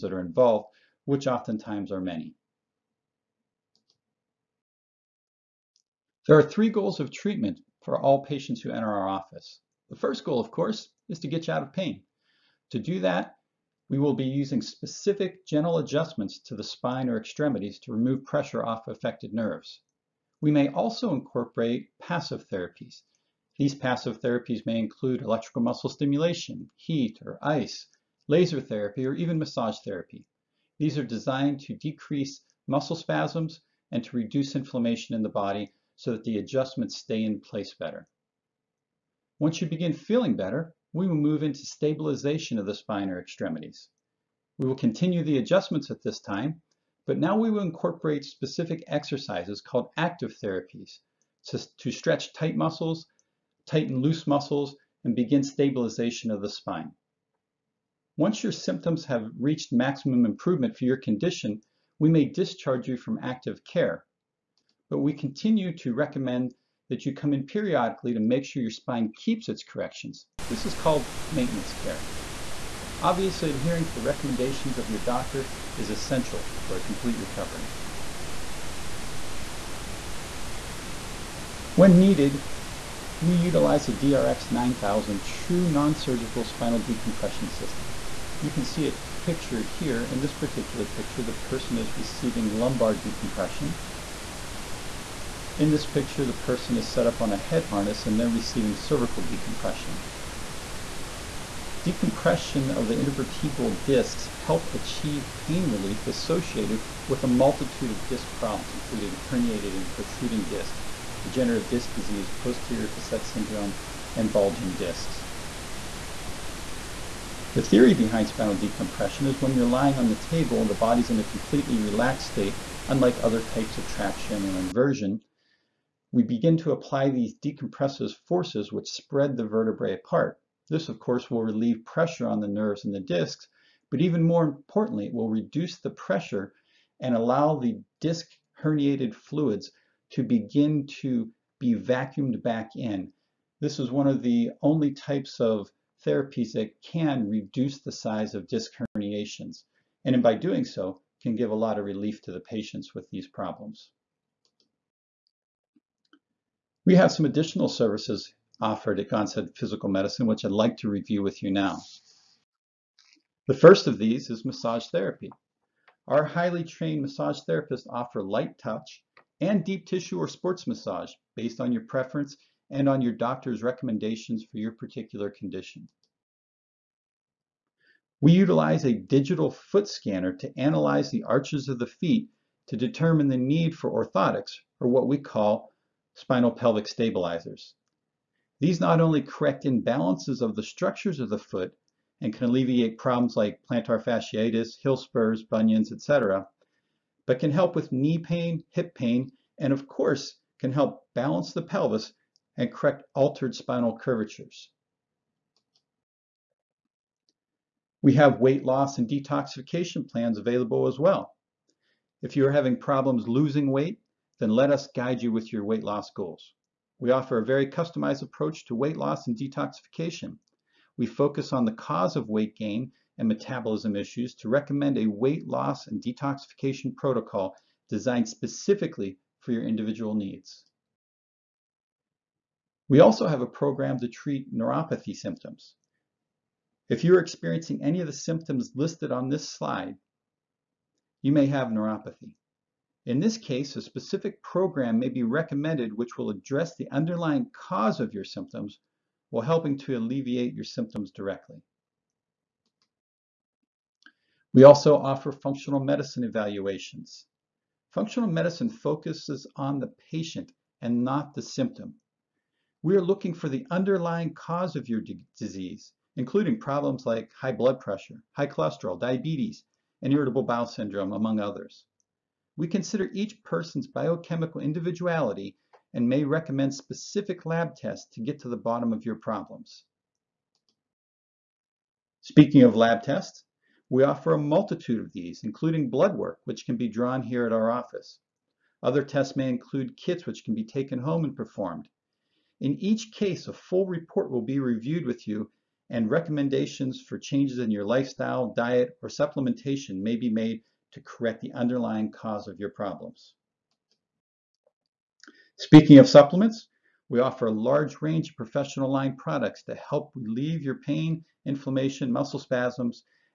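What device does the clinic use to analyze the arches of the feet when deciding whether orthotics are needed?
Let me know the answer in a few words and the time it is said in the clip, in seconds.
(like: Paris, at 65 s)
digital foot scanner, at 178 s.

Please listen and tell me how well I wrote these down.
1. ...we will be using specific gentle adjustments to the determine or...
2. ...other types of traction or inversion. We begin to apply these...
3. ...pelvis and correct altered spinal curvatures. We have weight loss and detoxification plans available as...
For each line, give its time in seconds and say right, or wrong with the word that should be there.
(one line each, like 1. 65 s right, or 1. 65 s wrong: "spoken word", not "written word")
1. 13 s wrong: "spine", not "determine"
2. 123 s right
3. 201 s right.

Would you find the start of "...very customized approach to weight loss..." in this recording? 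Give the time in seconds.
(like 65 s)
217 s.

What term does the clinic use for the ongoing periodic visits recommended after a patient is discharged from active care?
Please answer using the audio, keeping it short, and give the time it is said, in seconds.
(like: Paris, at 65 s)
maintenance care, at 71 s.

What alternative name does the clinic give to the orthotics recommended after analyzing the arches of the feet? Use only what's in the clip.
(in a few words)
spinal pelvic stabilizers.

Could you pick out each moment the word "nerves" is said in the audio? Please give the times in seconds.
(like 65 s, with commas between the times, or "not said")
19 s, 132 s.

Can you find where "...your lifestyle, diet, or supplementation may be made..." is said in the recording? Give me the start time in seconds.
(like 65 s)
297 s.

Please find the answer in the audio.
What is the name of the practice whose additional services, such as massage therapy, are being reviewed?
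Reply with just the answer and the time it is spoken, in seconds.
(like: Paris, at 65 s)
Gonstead Physical Medicine, at 159 s.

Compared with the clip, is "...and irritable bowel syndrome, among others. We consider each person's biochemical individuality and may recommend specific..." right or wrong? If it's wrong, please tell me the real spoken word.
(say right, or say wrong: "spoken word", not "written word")
right.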